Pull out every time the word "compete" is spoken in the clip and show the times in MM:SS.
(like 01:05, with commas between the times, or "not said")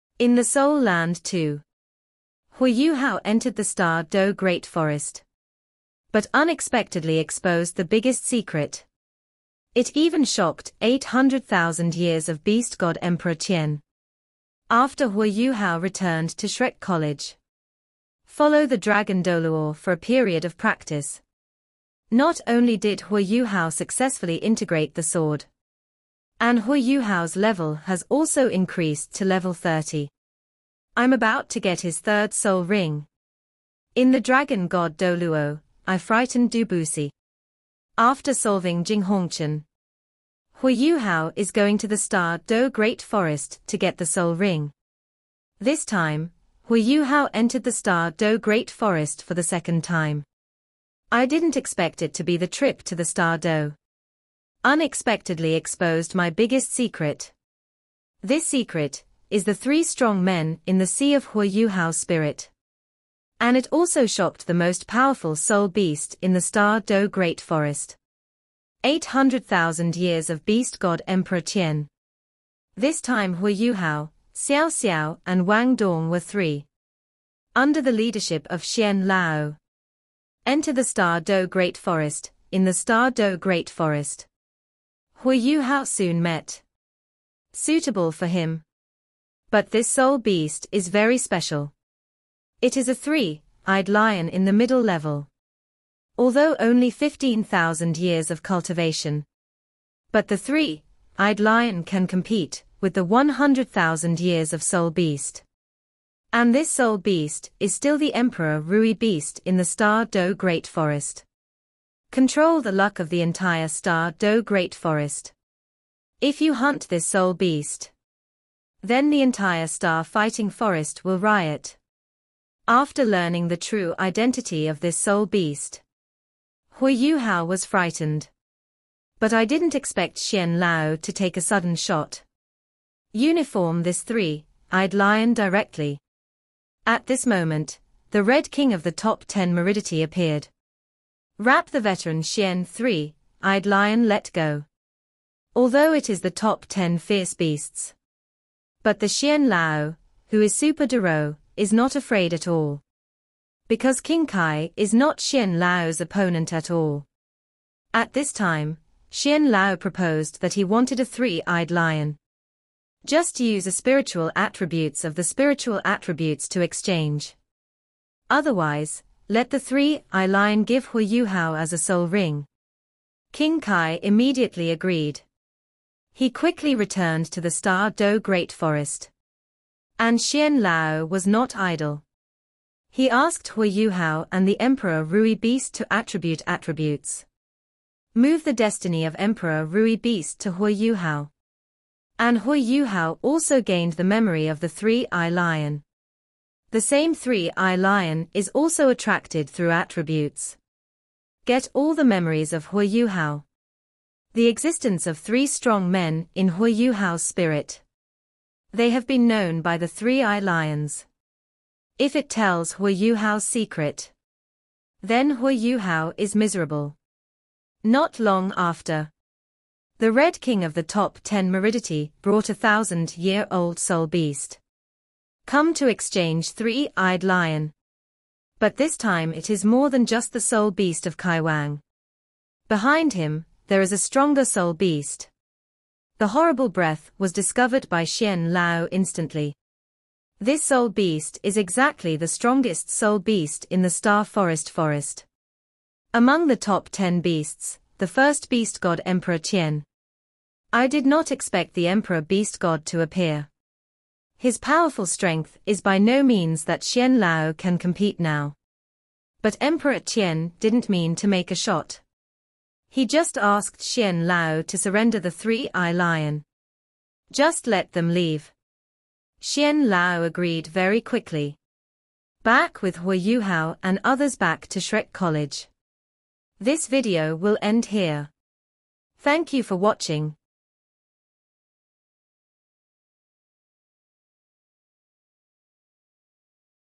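01:42, 04:17.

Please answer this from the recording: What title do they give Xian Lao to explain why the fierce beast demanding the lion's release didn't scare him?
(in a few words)
Super Douluo.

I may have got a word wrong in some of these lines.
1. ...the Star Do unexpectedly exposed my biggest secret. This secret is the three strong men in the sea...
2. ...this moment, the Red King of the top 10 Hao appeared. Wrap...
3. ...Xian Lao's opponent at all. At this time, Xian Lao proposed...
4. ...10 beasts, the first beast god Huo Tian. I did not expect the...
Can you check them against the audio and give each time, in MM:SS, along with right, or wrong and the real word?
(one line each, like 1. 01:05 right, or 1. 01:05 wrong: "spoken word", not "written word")
1. 00:52 right
2. 02:17 wrong: "Meridity", not "Hao"
3. 02:35 right
4. 04:06 wrong: "Emperor", not "Huo".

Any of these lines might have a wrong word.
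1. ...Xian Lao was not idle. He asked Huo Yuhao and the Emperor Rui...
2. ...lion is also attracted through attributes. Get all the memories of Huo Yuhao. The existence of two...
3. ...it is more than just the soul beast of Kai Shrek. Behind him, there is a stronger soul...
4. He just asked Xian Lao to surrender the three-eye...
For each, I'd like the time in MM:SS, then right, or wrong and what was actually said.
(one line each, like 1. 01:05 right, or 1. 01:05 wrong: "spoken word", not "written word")
1. 03:00 right
2. 03:17 wrong: "three", not "two"
3. 03:49 wrong: "Wang", not "Shrek"
4. 04:22 right.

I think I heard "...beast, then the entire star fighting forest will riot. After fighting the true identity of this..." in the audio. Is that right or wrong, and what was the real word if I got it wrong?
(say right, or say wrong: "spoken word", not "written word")
wrong: "learning", not "fighting".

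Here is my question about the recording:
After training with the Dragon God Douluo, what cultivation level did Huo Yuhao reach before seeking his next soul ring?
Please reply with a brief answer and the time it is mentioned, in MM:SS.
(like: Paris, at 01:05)
30, at 00:29.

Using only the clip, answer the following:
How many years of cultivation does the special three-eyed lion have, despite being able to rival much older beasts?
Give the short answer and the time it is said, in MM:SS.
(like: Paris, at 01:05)
15,000 years, at 01:36.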